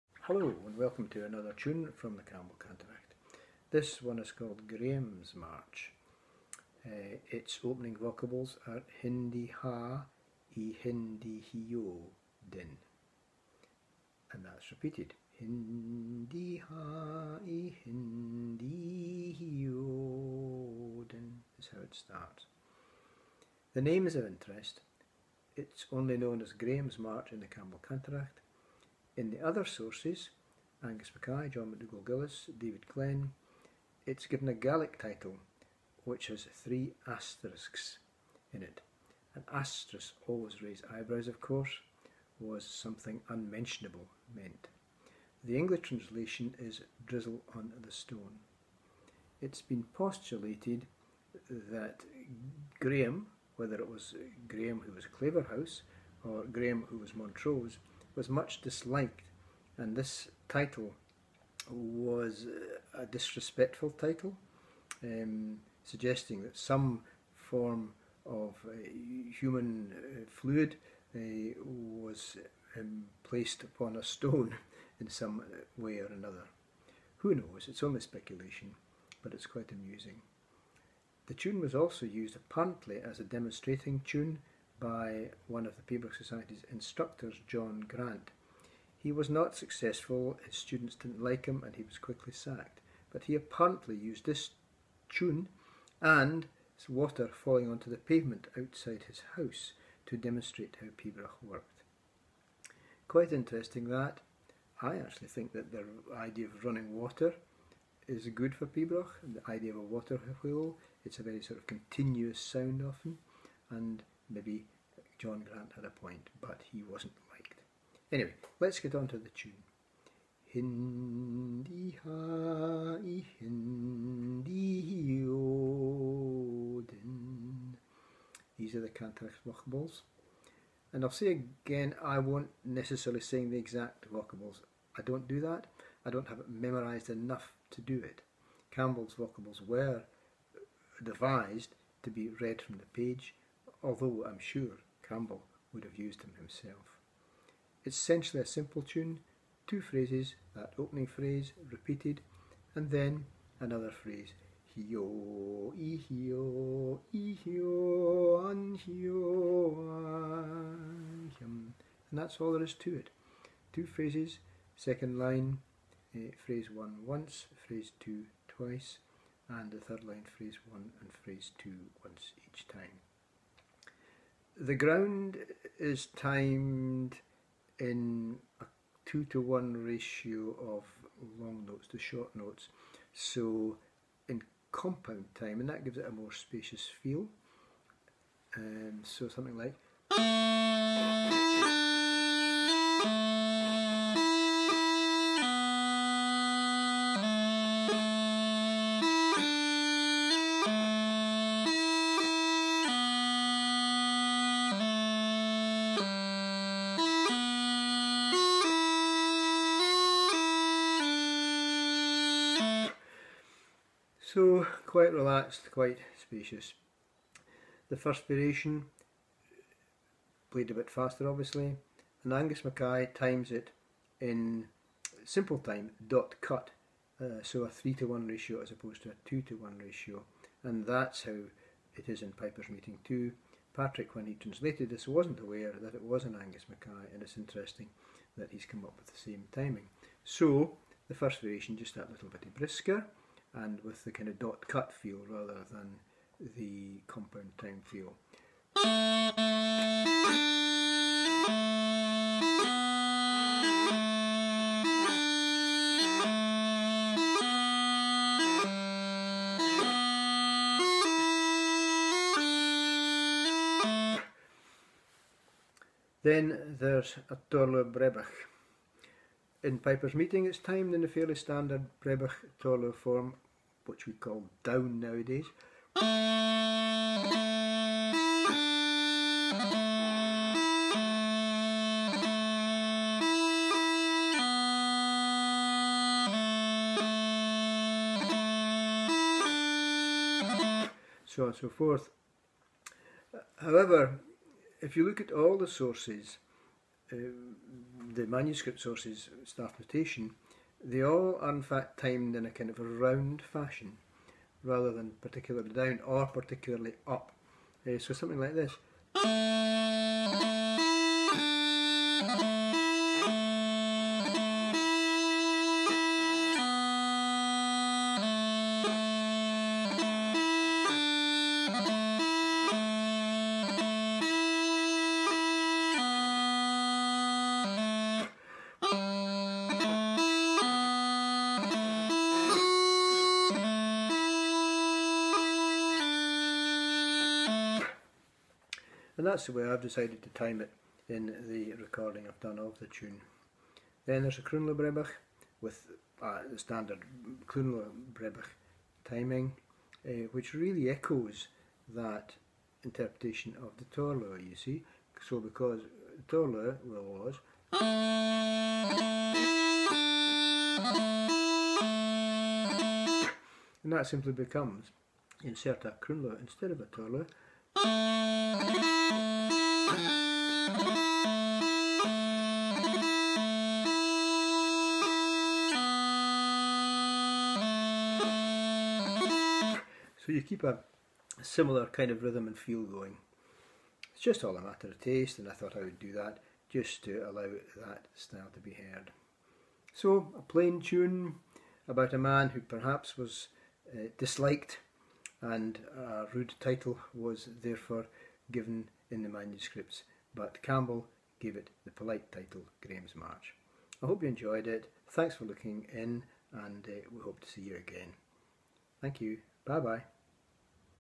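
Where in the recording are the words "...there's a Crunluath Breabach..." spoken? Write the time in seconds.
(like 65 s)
344 s.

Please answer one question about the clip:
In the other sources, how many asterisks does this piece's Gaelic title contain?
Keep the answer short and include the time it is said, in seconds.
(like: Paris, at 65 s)
3, at 36 s.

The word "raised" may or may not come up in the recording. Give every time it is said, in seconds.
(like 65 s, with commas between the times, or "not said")
40 s.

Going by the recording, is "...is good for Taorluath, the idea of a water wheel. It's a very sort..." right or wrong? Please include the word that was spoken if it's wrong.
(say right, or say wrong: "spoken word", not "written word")
wrong: "Pibroch", not "Taorluath".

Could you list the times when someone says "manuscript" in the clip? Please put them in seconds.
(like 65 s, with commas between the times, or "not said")
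298 s, 399 s.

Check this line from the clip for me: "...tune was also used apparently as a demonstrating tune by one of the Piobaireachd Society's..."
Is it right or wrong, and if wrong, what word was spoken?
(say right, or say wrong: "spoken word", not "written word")
right.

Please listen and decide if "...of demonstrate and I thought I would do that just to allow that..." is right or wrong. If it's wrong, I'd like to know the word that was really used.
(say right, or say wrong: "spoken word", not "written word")
wrong: "taste", not "demonstrate".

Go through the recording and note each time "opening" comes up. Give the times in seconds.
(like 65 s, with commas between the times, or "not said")
7 s, 150 s.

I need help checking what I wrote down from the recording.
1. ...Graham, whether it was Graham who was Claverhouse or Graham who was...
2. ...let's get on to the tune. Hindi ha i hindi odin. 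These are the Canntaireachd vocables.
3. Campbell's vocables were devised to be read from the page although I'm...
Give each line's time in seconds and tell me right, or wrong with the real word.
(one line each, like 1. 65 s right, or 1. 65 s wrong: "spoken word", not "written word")
1. 52 s right
2. 118 s right
3. 138 s right.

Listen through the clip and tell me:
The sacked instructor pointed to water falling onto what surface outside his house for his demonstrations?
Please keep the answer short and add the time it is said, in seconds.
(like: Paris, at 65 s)
The pavement, at 97 s.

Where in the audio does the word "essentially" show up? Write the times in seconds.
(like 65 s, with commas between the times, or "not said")
147 s.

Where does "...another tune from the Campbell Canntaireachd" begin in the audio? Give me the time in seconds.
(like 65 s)
1 s.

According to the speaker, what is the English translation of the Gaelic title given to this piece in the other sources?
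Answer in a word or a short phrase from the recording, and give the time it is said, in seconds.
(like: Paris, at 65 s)
Drizzle on the stone, at 47 s.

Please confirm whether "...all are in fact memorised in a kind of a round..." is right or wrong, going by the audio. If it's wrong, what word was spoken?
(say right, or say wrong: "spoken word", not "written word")
wrong: "timed", not "memorised".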